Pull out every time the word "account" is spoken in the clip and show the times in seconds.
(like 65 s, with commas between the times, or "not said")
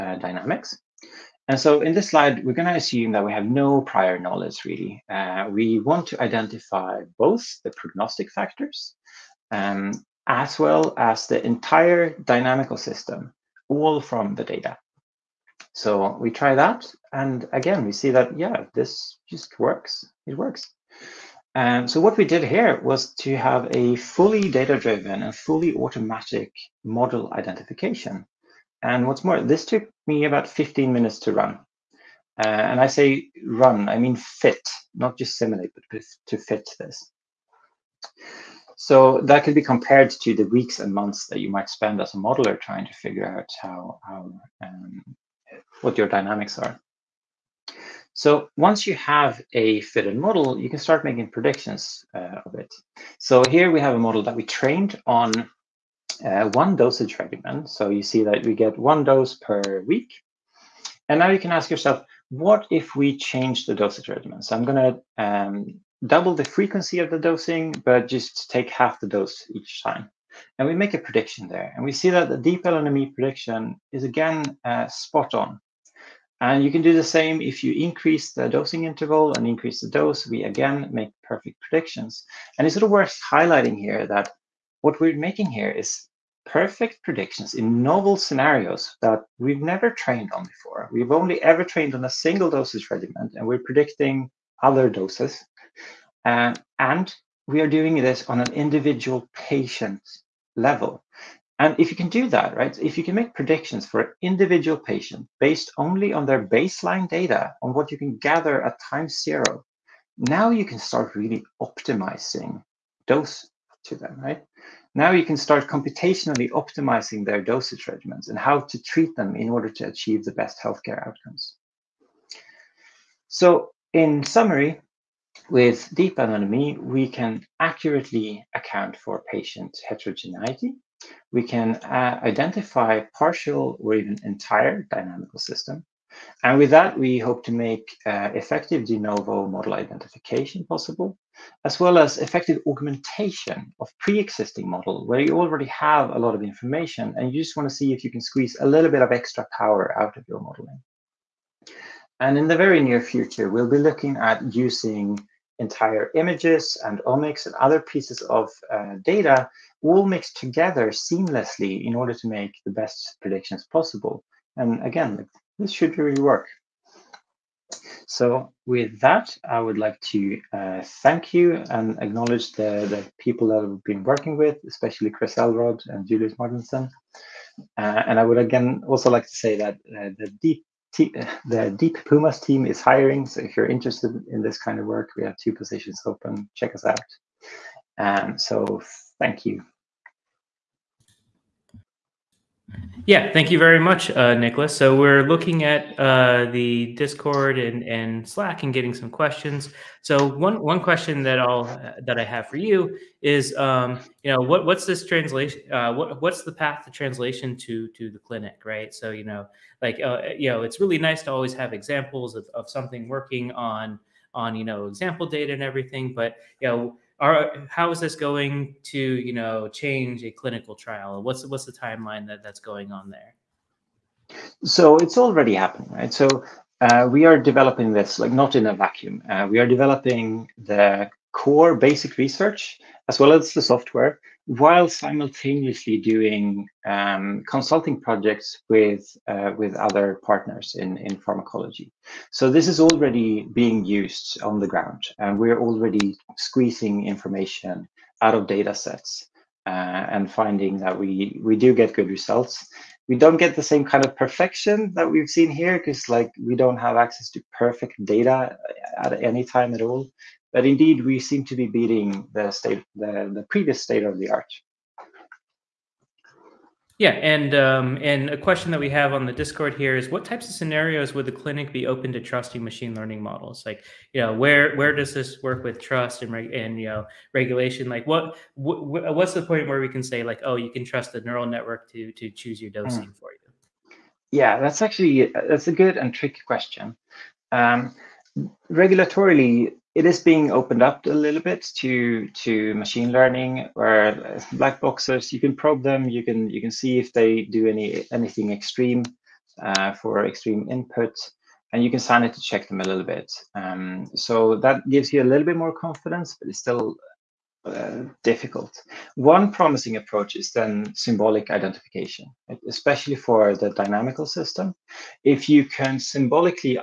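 128 s.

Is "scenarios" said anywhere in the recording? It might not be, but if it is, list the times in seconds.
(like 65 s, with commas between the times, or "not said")
88 s, 270 s.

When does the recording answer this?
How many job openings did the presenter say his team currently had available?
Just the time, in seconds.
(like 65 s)
185 s.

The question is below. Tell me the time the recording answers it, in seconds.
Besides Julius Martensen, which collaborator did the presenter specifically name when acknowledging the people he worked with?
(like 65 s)
175 s.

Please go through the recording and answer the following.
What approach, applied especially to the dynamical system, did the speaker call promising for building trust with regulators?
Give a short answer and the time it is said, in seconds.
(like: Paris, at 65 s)
symbolic identification, at 310 s.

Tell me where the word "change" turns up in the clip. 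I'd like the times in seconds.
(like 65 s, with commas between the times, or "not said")
63 s, 219 s.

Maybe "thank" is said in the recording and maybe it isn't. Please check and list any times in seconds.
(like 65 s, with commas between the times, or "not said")
171 s, 189 s, 193 s.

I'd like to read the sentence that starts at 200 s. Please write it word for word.
So one one question that I'll that I have for you is, um, you know, what what's this translation?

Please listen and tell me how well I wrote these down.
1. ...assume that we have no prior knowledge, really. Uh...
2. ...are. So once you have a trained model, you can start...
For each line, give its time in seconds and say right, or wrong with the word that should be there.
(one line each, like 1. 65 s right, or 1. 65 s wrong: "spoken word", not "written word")
1. 2 s right
2. 46 s wrong: "fitted", not "trained".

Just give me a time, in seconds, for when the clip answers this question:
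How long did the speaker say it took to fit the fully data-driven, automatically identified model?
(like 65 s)
30 s.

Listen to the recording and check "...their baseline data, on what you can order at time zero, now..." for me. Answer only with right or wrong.
wrong.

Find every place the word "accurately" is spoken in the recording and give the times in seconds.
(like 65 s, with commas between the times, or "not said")
127 s.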